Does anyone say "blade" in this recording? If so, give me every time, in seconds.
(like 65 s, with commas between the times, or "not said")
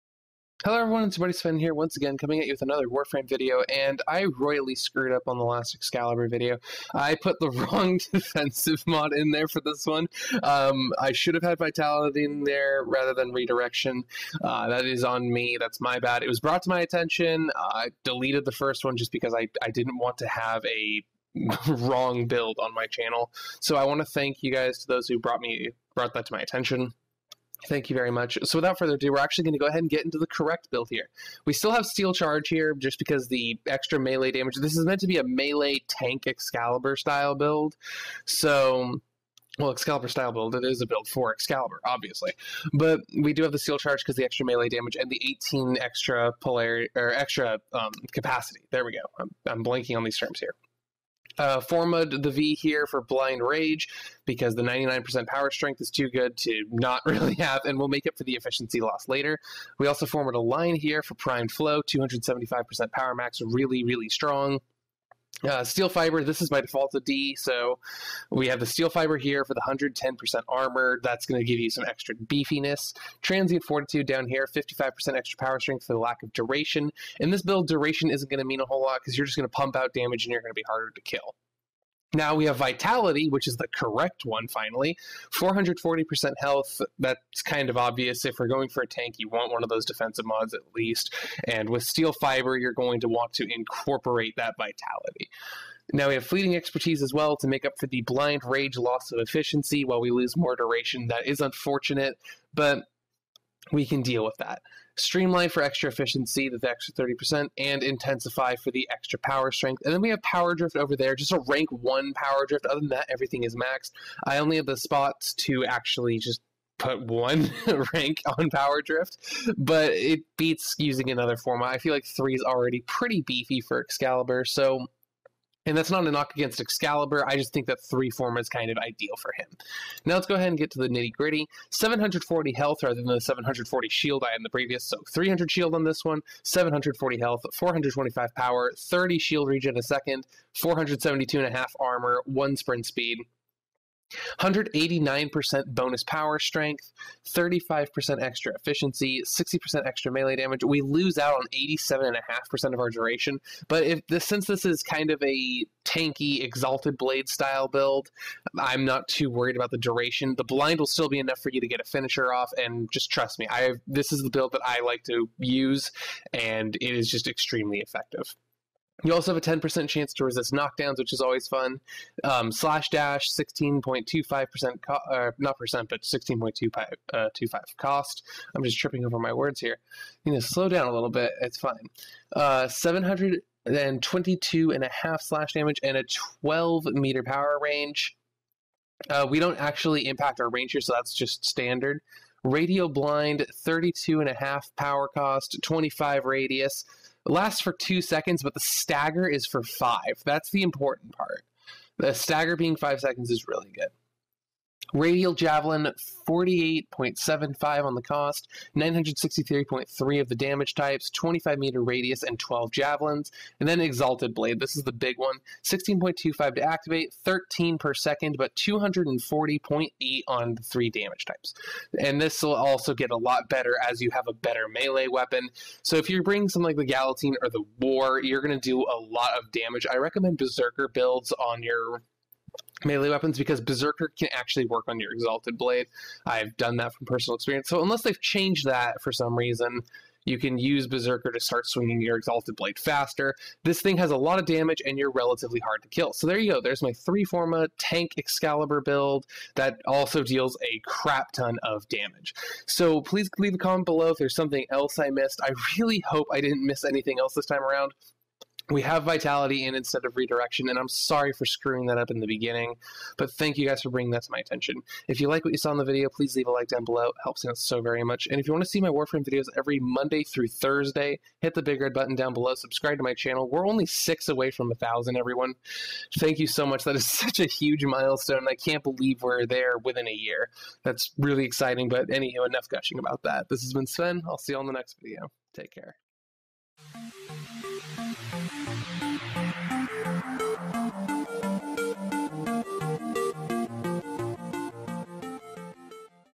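156 s, 214 s, 235 s, 242 s.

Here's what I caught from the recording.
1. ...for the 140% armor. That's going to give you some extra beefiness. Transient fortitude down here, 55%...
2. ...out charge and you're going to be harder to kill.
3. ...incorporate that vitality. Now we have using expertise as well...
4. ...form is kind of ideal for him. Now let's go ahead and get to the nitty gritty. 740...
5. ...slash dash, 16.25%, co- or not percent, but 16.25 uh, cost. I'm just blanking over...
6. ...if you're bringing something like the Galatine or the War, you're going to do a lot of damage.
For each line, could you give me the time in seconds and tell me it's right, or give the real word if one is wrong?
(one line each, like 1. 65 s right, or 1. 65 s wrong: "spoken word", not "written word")
1. 69 s wrong: "110", not "140"
2. 79 s wrong: "damage", not "charge"
3. 93 s wrong: "fleeting", not "using"
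4. 128 s right
5. 172 s wrong: "tripping", not "blanking"
6. 225 s right.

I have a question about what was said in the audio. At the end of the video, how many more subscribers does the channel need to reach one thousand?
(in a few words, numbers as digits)
6.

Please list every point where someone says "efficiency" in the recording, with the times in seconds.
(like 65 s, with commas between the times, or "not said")
58 s, 99 s, 105 s, 148 s.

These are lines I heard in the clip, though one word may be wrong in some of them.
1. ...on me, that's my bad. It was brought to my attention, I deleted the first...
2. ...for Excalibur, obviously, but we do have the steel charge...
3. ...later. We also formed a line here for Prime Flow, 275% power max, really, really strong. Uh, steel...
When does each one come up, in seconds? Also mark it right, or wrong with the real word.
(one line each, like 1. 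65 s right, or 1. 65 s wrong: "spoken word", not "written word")
1. 15 s right
2. 41 s right
3. 59 s right.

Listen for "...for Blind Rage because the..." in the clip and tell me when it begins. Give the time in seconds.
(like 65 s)
52 s.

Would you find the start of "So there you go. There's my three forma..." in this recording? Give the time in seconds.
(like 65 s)
246 s.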